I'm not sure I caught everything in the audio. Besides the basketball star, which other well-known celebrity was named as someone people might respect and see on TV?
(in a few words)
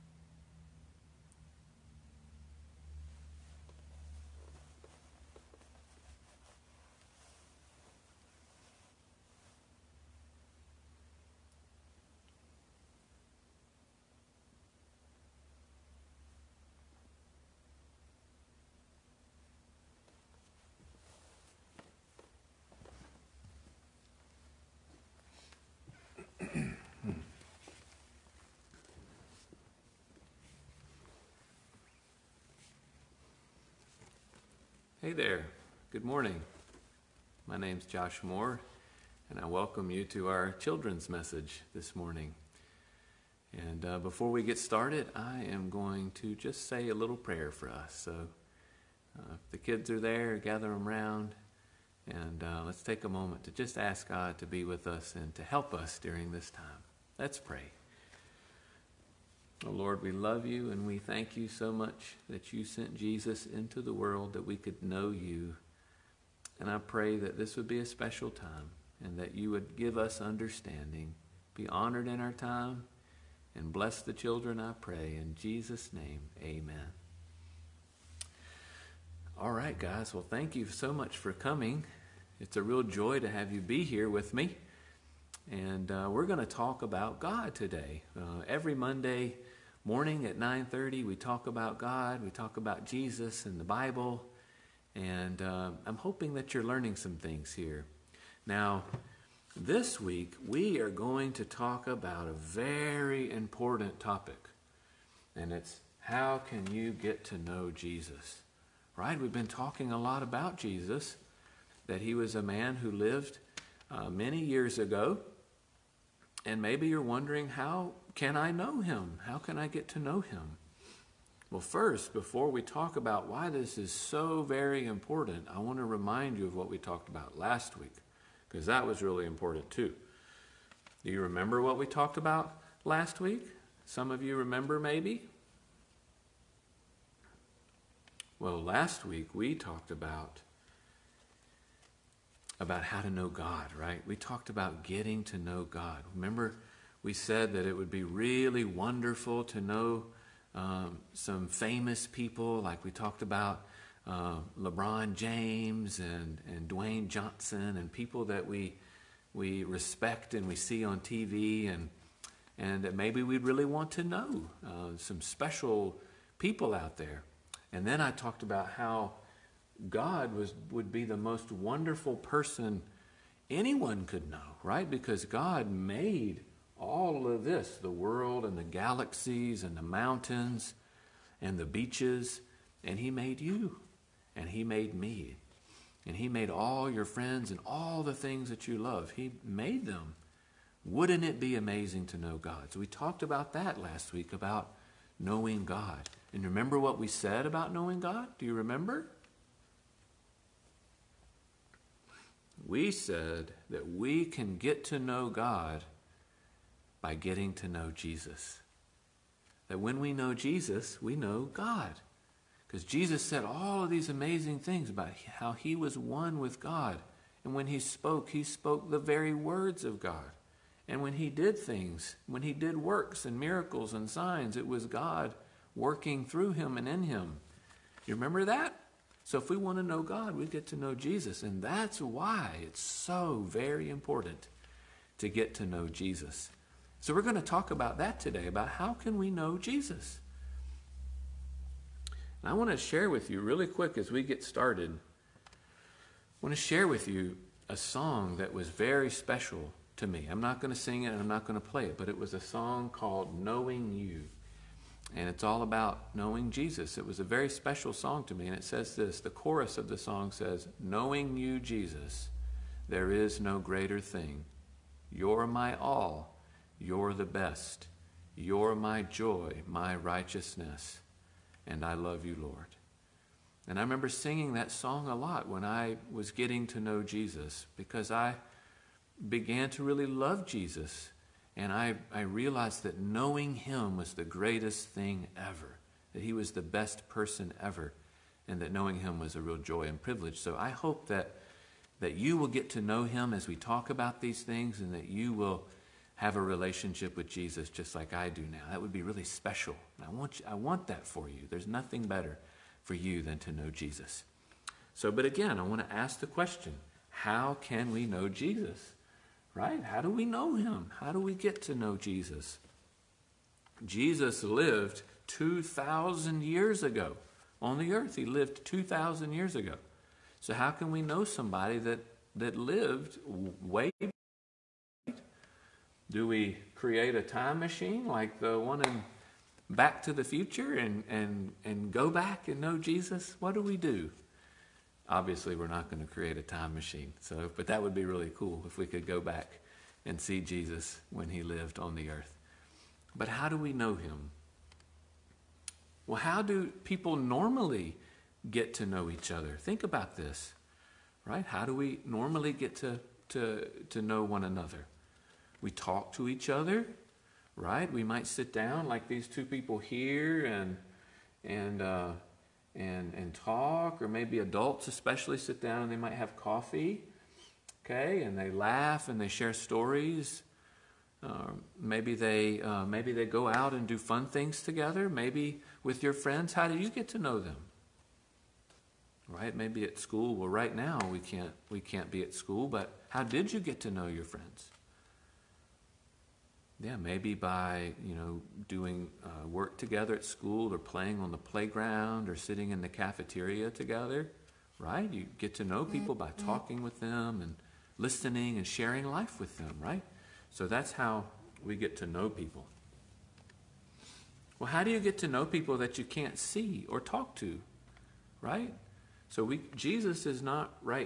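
Dwayne Johnson.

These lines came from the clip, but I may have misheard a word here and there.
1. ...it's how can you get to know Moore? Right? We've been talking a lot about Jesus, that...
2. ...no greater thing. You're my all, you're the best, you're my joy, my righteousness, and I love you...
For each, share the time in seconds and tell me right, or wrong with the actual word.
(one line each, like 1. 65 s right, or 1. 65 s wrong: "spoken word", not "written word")
1. 105 s wrong: "Jesus", not "Moore"
2. 263 s right.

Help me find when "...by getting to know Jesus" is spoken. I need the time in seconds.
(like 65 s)
207 s.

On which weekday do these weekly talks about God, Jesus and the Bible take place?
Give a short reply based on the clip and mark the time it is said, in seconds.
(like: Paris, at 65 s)
Monday, at 88 s.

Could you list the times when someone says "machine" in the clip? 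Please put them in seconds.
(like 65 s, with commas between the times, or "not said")
327 s, 336 s.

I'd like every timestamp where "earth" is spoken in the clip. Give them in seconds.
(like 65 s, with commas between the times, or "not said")
317 s, 342 s.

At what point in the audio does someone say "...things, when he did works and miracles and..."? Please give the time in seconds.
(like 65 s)
221 s.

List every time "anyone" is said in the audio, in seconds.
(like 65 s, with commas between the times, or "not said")
173 s.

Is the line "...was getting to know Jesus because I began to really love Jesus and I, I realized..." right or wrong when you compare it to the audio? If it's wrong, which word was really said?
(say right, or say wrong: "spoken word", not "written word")
right.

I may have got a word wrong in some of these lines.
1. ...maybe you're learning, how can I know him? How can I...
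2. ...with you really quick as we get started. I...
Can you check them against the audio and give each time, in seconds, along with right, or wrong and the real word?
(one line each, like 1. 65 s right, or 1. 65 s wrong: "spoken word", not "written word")
1. 116 s wrong: "wondering", not "learning"
2. 243 s right.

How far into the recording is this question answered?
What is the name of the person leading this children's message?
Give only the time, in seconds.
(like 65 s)
37 s.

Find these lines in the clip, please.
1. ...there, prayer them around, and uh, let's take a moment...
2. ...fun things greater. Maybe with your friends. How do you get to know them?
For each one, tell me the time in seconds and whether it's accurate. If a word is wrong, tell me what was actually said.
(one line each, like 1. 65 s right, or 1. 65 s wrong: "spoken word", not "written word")
1. 49 s wrong: "gather", not "prayer"
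2. 373 s wrong: "together", not "greater".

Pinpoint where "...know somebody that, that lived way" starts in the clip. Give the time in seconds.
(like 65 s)
321 s.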